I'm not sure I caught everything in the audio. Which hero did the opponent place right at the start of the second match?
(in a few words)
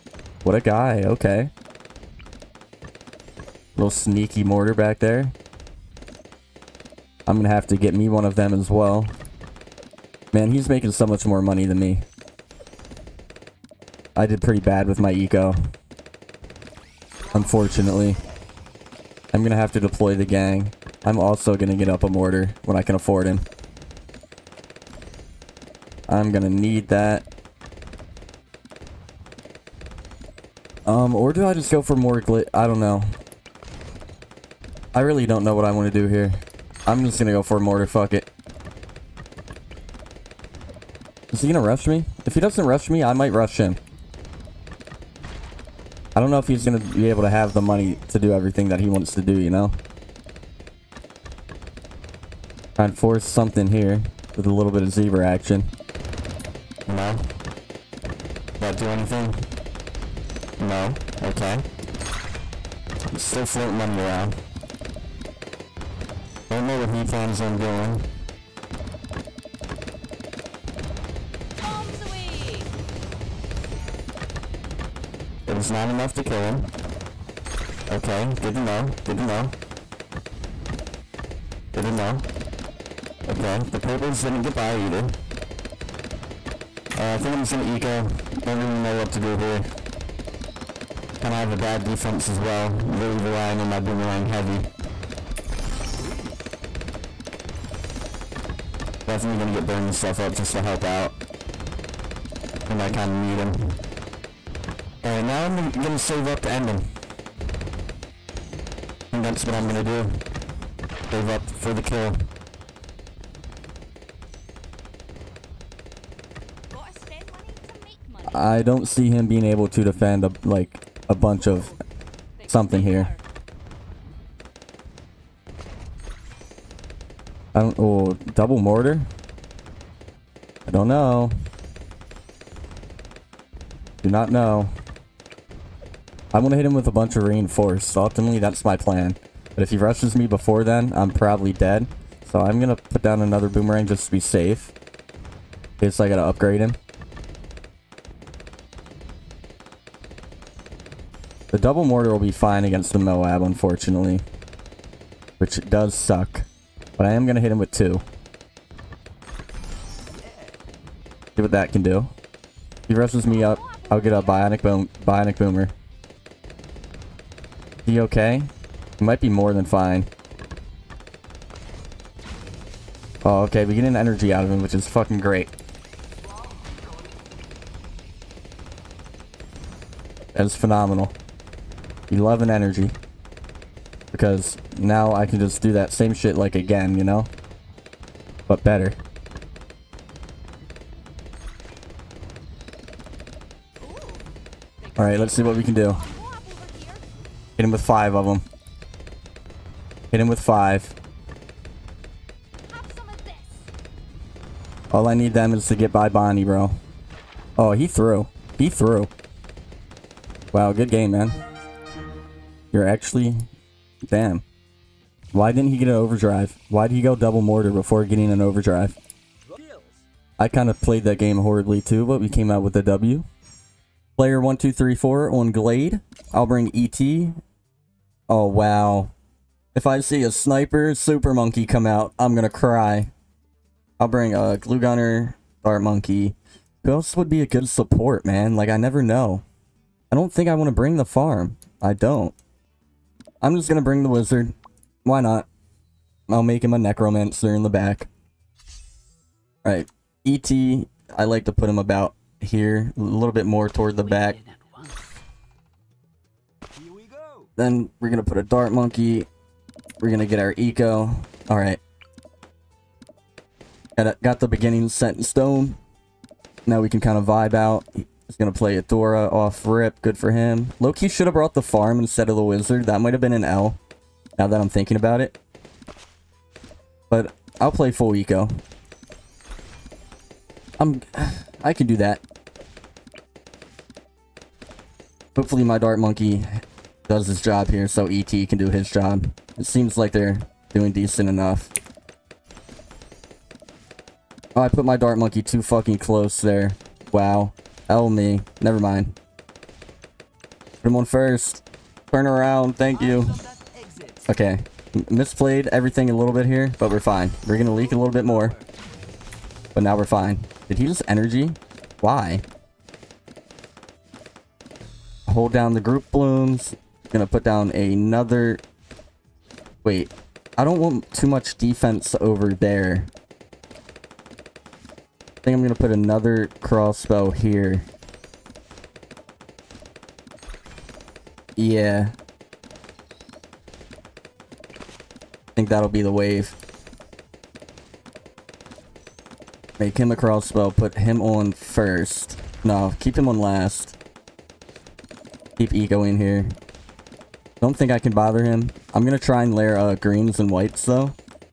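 Adora.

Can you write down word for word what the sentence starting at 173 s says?
Oh, okay, we get an energy out of him, which is fucking great.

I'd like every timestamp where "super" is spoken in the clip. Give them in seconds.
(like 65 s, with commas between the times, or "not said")
230 s.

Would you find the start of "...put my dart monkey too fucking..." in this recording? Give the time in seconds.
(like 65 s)
294 s.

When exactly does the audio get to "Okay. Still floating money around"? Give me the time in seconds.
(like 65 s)
61 s.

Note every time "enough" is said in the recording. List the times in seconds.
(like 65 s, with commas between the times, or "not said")
75 s, 291 s.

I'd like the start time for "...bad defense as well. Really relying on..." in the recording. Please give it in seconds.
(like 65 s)
91 s.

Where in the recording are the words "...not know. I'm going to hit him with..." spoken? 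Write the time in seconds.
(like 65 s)
134 s.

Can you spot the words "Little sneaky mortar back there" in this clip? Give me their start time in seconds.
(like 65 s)
3 s.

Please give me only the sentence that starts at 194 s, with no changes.
Alright, let's see what we can do.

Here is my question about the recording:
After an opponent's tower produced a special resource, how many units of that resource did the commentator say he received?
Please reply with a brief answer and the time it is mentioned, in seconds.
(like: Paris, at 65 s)
11, at 182 s.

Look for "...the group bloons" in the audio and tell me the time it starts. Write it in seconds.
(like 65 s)
315 s.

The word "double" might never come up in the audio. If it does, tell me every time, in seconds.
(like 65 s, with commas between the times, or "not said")
128 s, 151 s, 217 s.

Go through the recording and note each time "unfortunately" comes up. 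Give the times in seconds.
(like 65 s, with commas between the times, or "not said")
17 s, 153 s.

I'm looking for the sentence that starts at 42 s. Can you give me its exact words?
If he doesn't rush me, I might rush him.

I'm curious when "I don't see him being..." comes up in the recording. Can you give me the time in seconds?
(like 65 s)
118 s.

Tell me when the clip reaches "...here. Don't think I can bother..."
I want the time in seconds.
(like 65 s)
346 s.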